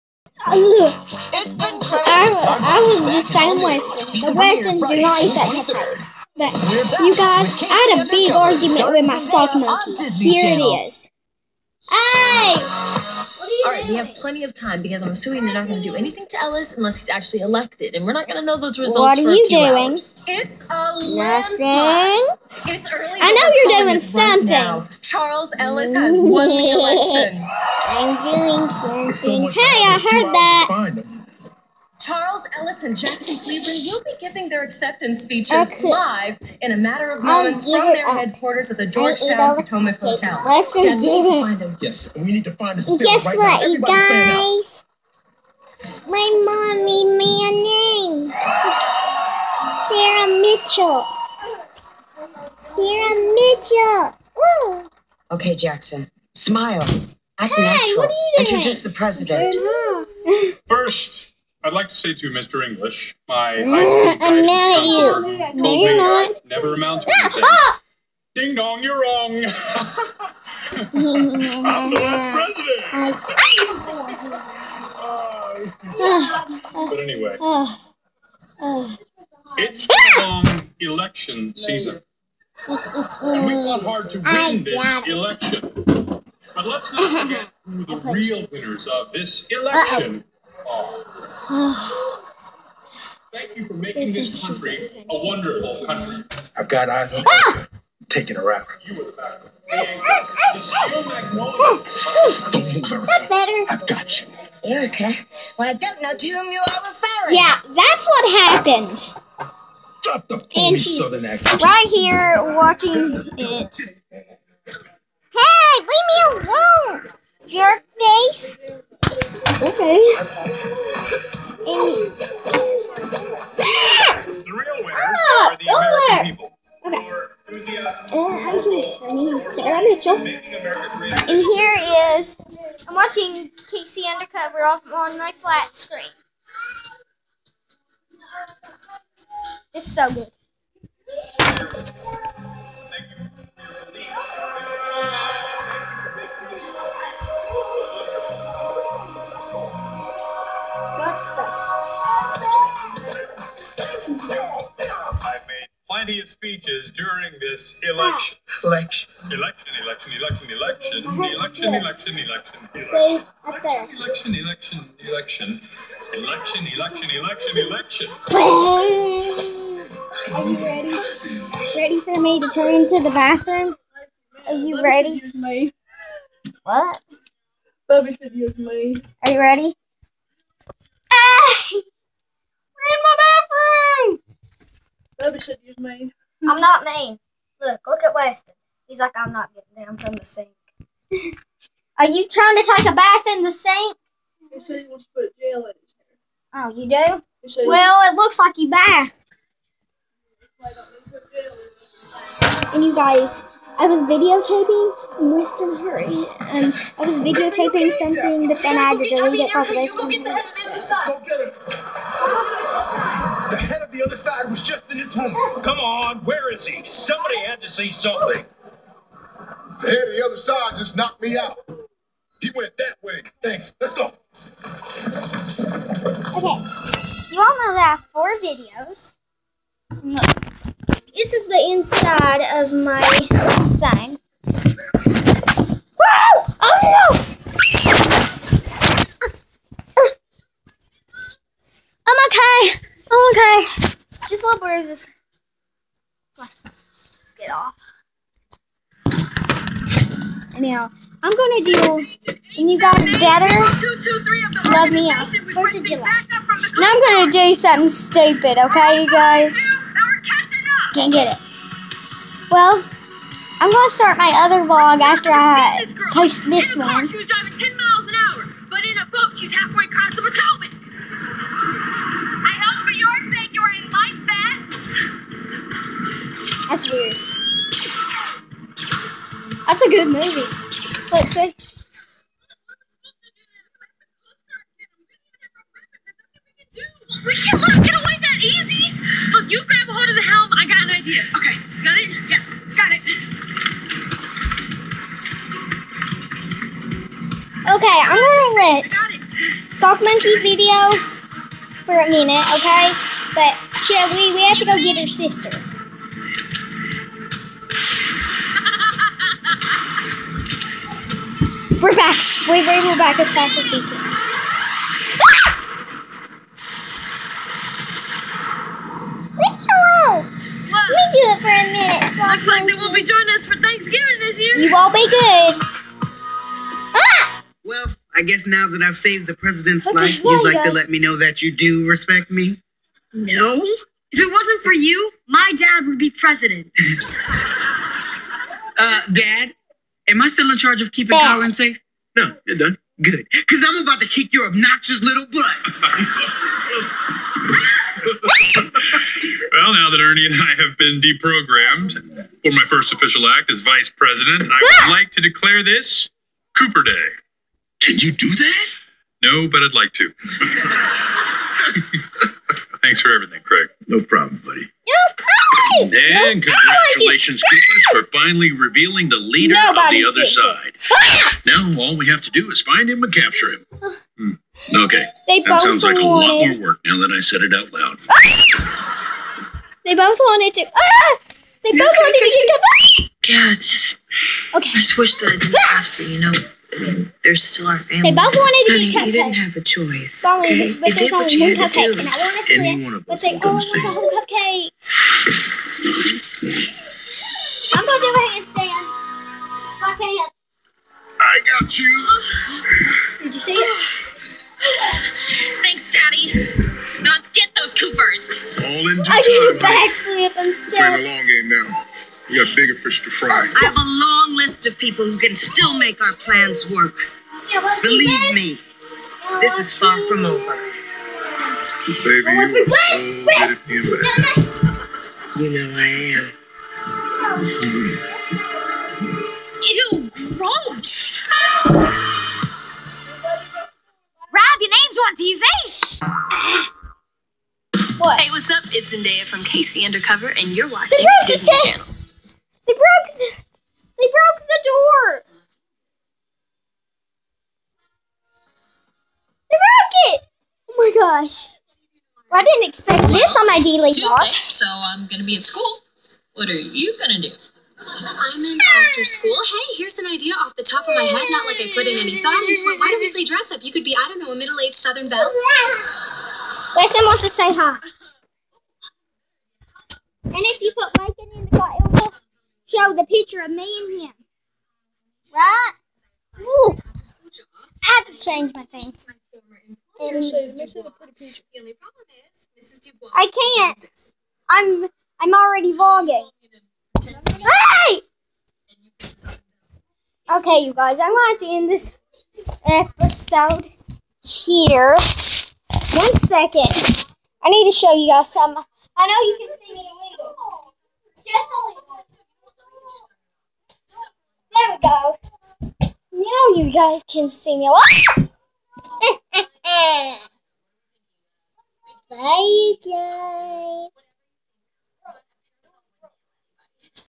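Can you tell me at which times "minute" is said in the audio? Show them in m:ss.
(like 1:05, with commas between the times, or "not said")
5:02, 5:21.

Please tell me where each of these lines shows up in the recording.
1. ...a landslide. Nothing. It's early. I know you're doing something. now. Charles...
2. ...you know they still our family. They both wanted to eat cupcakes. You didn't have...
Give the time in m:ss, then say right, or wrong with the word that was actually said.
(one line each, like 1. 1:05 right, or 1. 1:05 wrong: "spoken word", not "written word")
1. 0:20 right
2. 6:26 right.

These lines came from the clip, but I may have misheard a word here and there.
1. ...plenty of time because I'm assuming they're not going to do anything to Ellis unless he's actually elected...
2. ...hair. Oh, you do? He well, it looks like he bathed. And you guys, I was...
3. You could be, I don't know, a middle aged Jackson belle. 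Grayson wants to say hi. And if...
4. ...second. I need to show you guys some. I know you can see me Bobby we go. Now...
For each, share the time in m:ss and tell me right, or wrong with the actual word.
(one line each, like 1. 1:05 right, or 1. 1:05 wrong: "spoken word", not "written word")
1. 0:14 right
2. 3:15 right
3. 7:43 wrong: "Southern", not "Jackson"
4. 8:16 wrong: "There", not "Bobby".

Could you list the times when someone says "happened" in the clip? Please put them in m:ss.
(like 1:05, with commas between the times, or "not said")
1:48.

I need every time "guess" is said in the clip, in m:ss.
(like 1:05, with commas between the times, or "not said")
0:42, 5:28.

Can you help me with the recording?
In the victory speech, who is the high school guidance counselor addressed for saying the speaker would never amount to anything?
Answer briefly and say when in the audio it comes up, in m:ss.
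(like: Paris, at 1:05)
Mr. English, at 1:02.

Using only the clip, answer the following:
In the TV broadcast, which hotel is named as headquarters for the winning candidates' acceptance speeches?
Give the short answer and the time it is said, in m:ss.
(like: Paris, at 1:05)
Georgetown Potomac Hotel, at 0:38.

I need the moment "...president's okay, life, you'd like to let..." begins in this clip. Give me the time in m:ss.
5:29.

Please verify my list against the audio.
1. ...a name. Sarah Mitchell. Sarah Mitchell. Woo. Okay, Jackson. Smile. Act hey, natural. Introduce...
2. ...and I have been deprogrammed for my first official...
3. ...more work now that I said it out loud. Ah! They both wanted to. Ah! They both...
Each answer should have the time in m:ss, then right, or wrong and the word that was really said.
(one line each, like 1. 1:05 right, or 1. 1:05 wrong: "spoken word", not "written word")
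1. 0:47 right
2. 5:50 right
3. 6:16 right.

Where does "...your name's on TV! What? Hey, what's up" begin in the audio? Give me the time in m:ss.
7:14.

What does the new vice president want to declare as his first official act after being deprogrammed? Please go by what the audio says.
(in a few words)
Cooper Day.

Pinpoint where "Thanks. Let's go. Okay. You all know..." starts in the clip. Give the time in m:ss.
3:43.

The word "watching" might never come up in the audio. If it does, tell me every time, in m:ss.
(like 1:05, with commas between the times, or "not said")
1:52, 2:12, 7:20.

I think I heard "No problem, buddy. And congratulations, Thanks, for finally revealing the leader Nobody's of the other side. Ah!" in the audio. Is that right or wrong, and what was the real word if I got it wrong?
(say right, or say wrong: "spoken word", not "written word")
wrong: "Coopers", not "Thanks".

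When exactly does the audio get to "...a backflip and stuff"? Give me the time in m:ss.
6:49.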